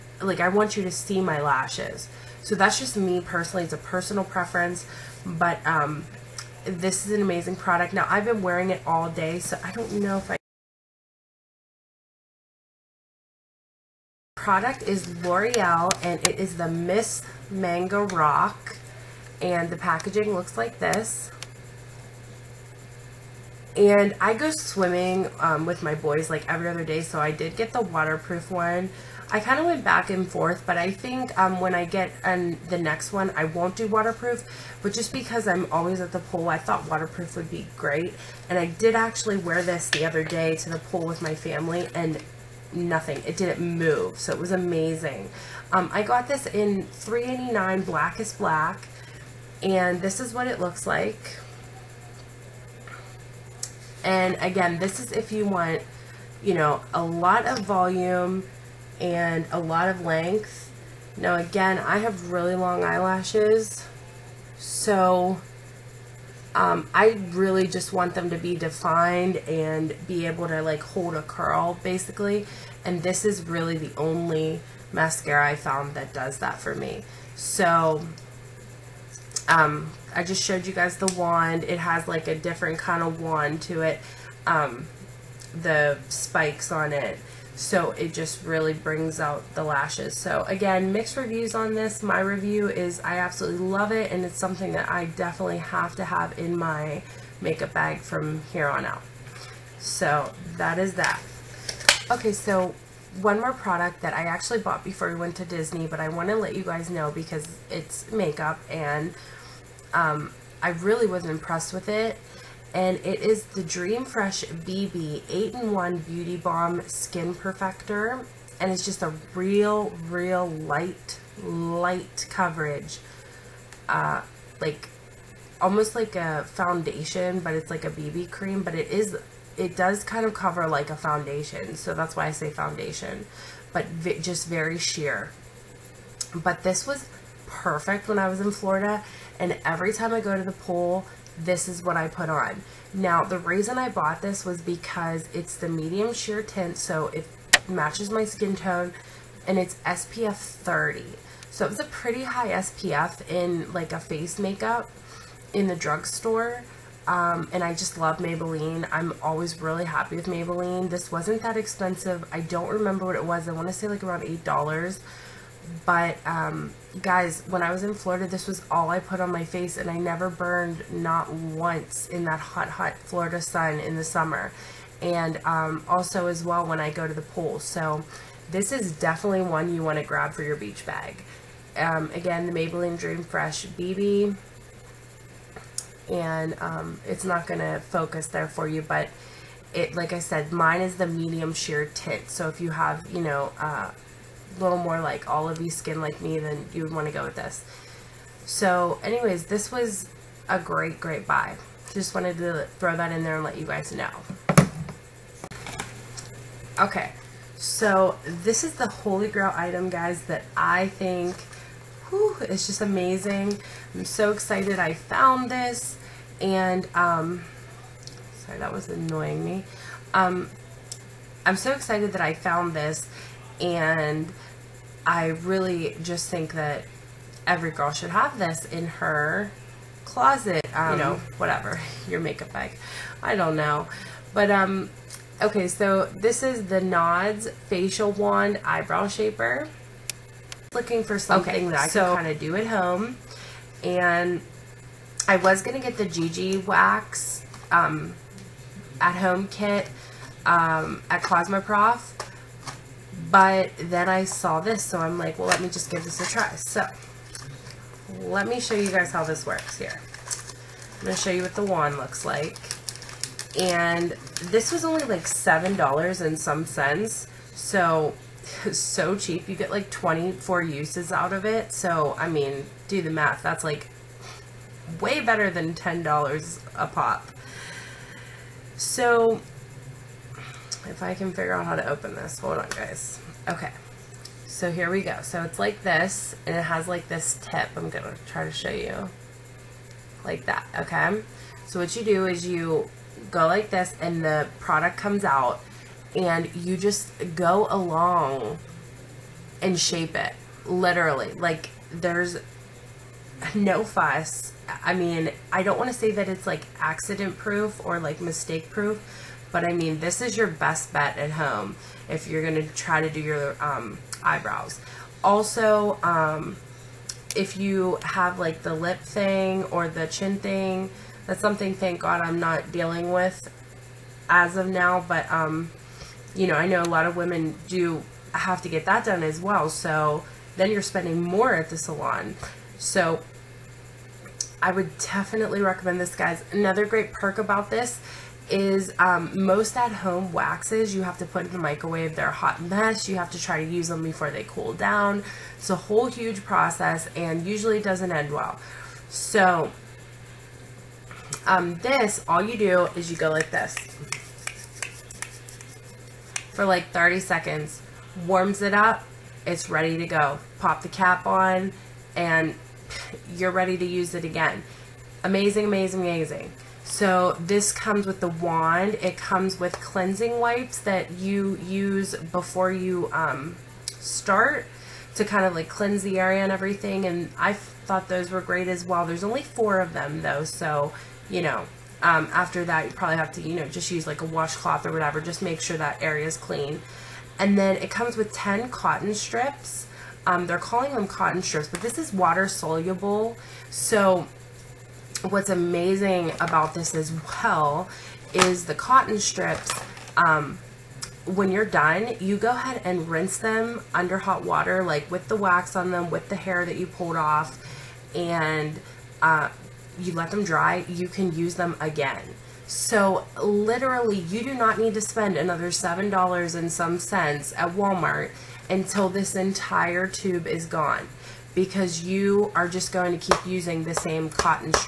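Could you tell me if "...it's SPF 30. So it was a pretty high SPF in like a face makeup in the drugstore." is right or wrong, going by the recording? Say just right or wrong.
right.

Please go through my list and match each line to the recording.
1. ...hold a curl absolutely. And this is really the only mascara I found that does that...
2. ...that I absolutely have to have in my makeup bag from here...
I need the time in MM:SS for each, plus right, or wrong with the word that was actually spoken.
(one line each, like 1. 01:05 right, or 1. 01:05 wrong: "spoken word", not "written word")
1. 01:10 wrong: "basically", not "absolutely"
2. 01:34 wrong: "definitely", not "absolutely".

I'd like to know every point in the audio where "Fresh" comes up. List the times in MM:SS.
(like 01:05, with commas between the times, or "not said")
01:54, 03:03.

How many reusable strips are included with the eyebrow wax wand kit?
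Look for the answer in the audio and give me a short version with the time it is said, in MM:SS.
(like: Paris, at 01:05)
10, at 06:28.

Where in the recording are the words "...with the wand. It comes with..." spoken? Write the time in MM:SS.
06:08.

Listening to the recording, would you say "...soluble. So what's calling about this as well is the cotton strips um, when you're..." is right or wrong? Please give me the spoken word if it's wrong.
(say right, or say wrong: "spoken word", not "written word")
wrong: "amazing", not "calling".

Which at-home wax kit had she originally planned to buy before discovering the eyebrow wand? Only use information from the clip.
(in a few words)
Gigi Wax.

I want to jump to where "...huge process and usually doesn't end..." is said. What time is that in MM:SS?
05:46.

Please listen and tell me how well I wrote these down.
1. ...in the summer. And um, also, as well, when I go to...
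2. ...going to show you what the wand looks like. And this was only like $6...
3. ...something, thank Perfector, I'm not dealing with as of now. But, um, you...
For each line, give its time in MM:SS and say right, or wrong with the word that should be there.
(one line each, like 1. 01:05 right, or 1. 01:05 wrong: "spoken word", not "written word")
1. 02:53 right
2. 04:21 wrong: "7", not "6"
3. 05:21 wrong: "God", not "Perfector".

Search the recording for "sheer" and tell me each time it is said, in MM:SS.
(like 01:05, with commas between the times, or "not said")
02:14, 02:26, 03:11.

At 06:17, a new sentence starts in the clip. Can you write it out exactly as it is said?
And I thought those were great as well.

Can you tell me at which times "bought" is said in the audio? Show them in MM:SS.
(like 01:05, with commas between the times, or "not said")
01:44, 02:23.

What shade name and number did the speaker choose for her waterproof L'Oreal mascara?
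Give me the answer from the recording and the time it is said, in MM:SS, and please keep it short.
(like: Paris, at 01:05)
389 black is black, at 00:46.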